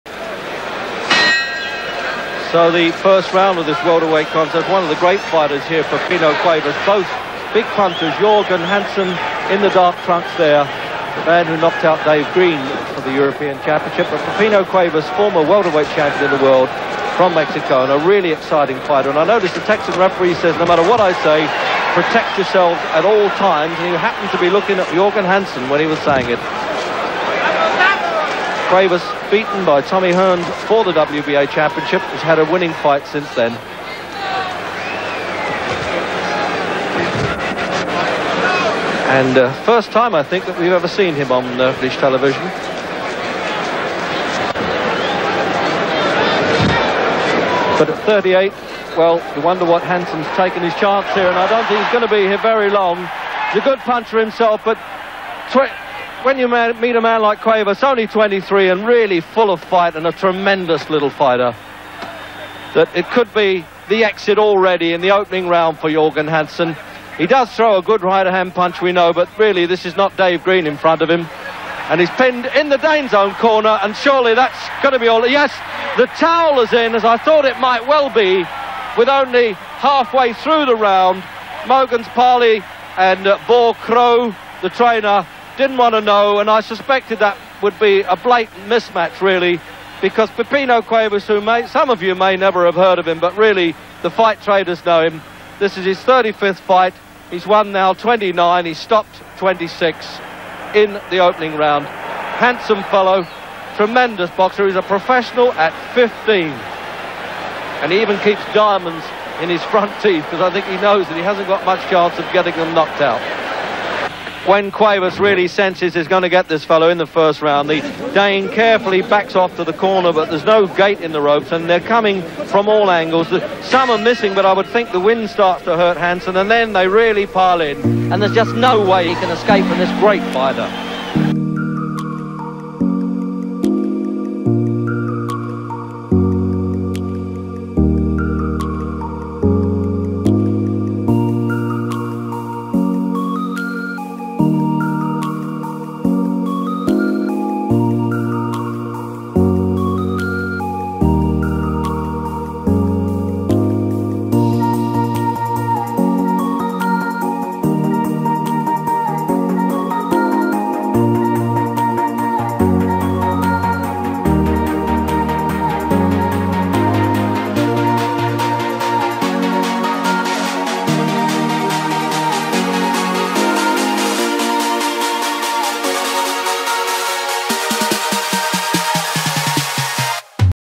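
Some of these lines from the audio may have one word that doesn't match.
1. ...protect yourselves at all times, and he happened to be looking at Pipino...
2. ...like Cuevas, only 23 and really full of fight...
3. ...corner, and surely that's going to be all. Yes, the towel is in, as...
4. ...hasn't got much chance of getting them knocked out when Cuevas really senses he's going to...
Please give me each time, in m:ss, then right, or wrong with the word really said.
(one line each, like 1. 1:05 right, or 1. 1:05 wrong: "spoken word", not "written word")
1. 0:21 wrong: "Jorgen", not "Pipino"
2. 0:57 right
3. 1:13 right
4. 1:51 right.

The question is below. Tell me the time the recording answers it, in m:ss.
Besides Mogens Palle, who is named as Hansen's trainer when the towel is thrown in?
1:23.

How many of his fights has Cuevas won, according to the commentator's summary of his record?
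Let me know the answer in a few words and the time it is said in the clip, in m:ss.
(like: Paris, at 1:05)
29, at 1:37.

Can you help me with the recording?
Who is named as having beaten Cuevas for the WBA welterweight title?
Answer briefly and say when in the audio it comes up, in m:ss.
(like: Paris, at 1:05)
Tommy Hearns, at 0:29.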